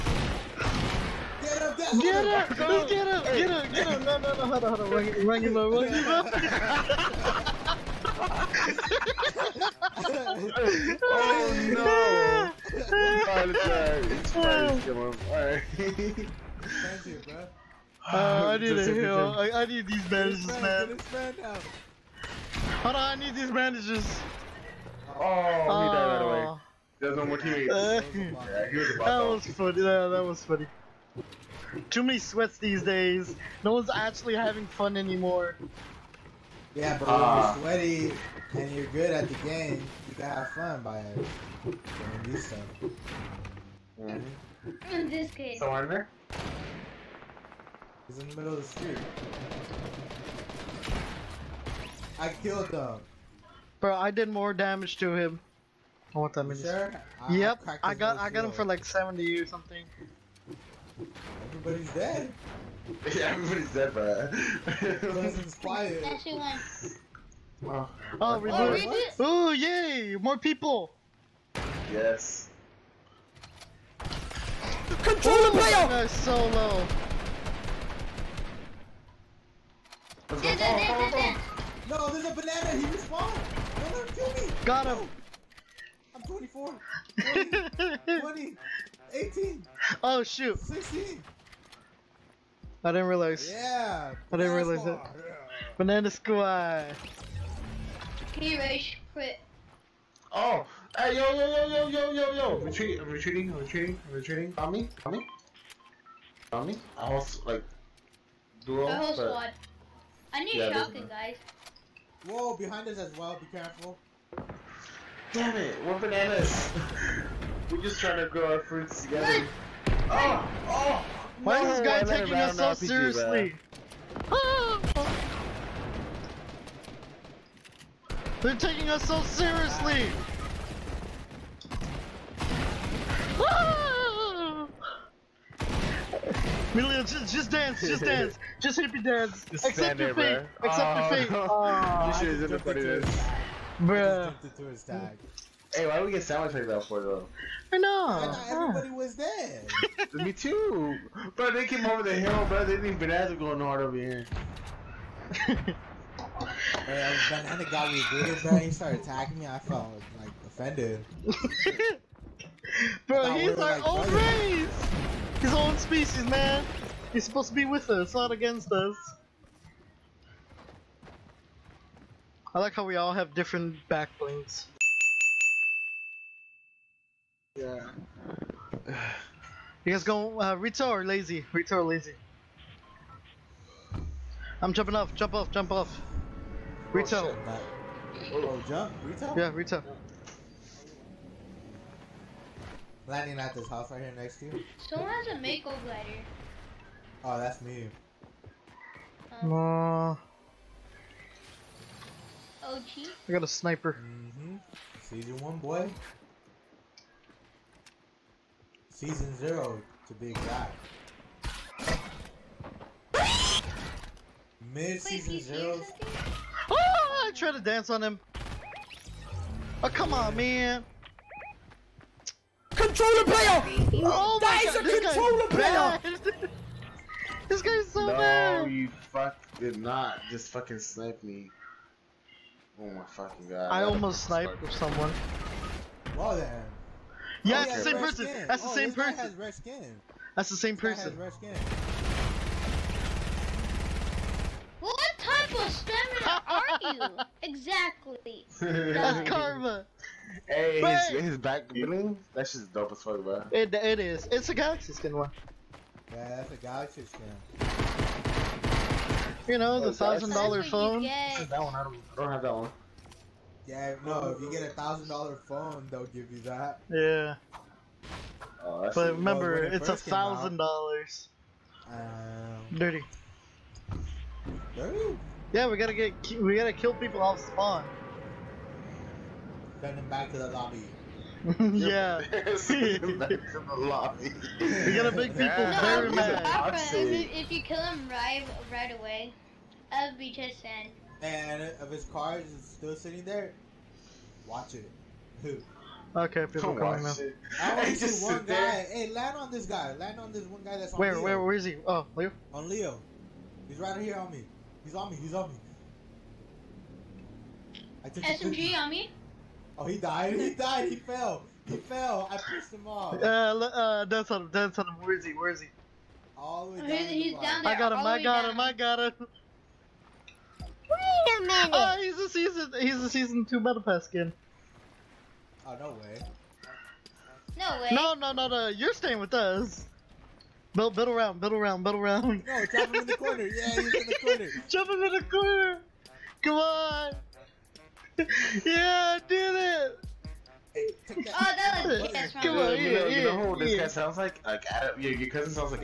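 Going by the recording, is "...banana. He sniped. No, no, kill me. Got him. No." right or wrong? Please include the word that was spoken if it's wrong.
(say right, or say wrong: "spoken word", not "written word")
wrong: "respawned", not "sniped".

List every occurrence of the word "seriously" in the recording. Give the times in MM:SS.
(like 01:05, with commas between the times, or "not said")
02:02, 02:09.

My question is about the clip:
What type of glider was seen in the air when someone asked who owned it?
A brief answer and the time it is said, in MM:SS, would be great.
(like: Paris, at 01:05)
Mako glider, at 03:15.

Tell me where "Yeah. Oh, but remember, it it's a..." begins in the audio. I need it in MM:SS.
04:26.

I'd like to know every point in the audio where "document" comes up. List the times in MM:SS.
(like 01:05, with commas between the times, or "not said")
not said.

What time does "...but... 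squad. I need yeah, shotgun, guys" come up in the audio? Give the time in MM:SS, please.
01:49.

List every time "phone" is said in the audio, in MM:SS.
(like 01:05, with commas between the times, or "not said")
04:20, 04:25.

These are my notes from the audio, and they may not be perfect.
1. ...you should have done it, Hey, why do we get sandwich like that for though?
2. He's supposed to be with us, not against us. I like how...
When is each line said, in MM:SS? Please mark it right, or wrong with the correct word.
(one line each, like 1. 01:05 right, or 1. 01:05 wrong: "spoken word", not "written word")
1. 02:22 right
2. 02:47 right.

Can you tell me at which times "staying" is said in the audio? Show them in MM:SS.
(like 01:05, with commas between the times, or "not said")
05:28.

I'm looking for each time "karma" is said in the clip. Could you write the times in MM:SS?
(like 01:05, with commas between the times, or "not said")
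04:09.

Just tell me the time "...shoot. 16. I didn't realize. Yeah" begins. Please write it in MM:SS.
01:30.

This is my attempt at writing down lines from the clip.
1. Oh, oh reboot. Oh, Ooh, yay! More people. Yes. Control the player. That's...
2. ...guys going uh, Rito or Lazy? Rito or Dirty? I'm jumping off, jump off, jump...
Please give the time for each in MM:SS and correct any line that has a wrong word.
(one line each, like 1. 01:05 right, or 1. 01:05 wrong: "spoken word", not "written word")
1. 01:08 right
2. 02:59 wrong: "Lazy", not "Dirty".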